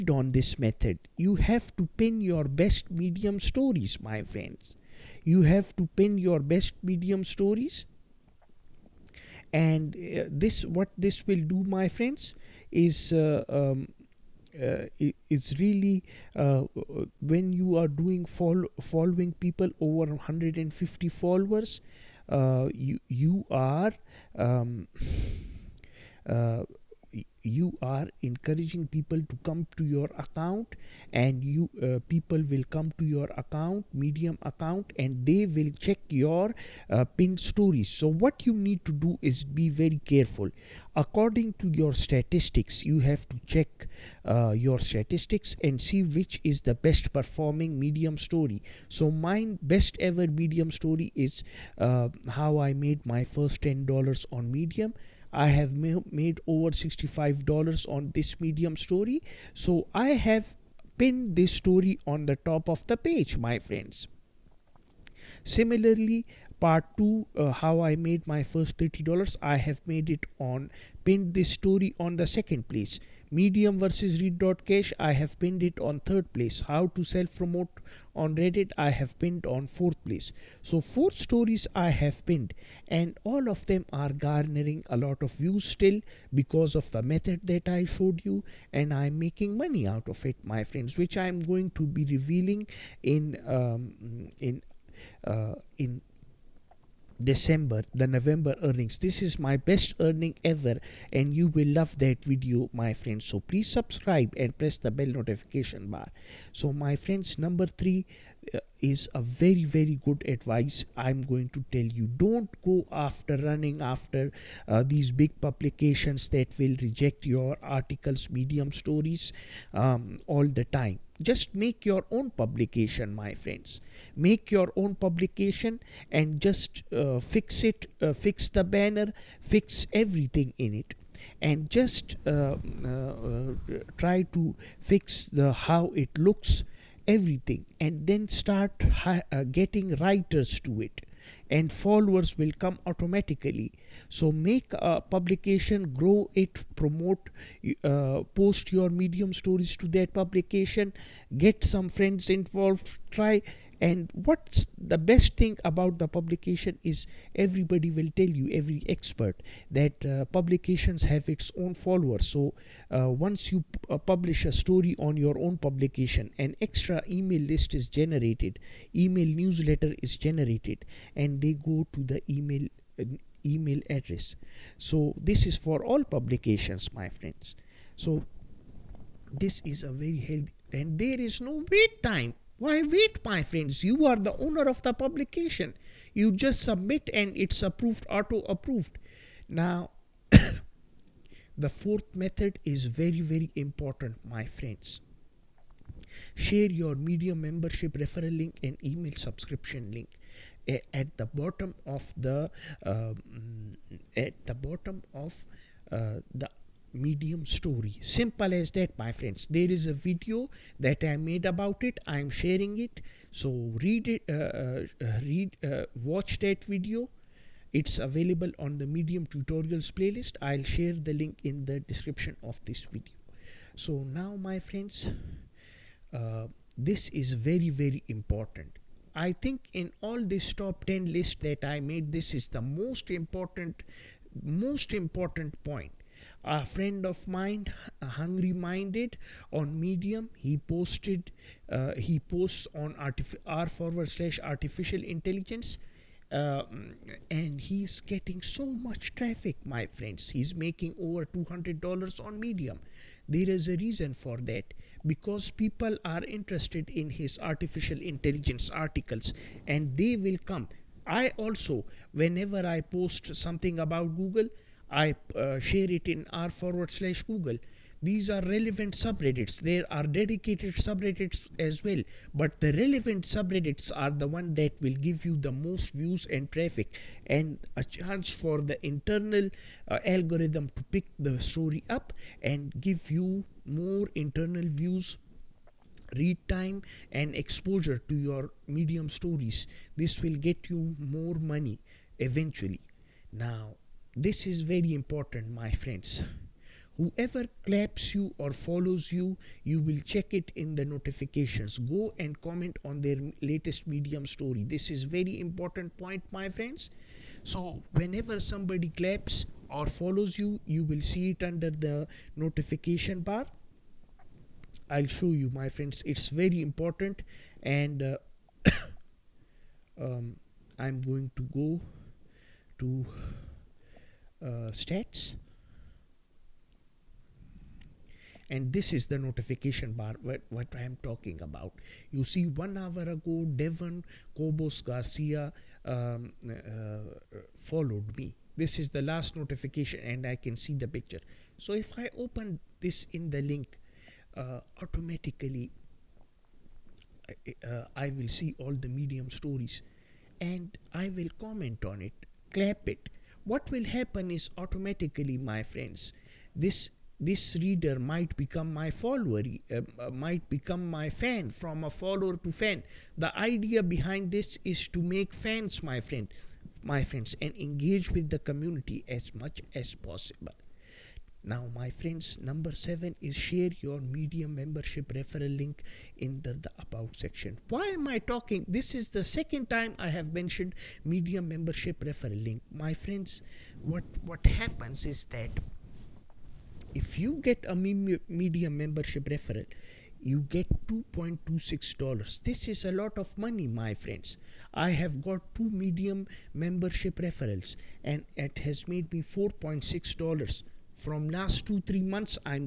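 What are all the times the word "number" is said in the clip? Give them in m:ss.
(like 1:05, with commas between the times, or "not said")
1:47, 6:12.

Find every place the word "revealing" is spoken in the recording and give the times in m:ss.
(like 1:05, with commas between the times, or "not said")
1:32.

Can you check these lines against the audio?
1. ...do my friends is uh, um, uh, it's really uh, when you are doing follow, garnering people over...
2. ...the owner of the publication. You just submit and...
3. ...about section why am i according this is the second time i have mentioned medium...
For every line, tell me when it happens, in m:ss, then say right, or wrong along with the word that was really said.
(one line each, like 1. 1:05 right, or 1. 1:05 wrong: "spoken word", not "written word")
1. 0:11 wrong: "following", not "garnering"
2. 3:04 right
3. 6:16 wrong: "talking", not "according".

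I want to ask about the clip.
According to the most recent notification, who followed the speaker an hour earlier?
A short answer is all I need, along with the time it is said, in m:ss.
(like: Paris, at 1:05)
Devon Cobos Garcia, at 5:33.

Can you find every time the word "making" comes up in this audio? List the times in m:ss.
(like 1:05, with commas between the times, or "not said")
1:29, 4:10.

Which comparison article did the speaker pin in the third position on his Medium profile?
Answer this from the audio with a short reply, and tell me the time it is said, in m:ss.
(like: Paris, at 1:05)
Medium versus read.cash, at 1:13.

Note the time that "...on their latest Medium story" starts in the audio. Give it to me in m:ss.
5:02.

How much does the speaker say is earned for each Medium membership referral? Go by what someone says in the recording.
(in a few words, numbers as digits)
$2.26.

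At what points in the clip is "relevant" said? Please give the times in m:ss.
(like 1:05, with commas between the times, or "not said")
4:28, 4:32.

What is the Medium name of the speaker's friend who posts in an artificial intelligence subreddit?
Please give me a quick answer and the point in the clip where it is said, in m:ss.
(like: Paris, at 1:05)
Hungry Minded, at 3:58.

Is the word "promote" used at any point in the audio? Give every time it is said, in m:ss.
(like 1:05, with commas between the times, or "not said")
1:17, 2:26.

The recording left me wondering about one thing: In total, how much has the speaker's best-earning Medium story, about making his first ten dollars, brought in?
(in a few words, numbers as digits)
$65.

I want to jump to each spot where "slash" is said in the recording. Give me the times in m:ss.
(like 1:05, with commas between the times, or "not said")
4:04, 4:26.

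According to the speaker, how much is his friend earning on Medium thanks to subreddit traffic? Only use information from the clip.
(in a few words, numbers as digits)
over $200.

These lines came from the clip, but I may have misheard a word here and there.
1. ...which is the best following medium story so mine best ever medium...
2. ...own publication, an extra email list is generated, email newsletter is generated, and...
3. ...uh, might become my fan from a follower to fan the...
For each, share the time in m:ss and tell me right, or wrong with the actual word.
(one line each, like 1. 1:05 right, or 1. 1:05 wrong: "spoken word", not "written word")
1. 0:46 wrong: "performing", not "following"
2. 2:45 right
3. 5:59 right.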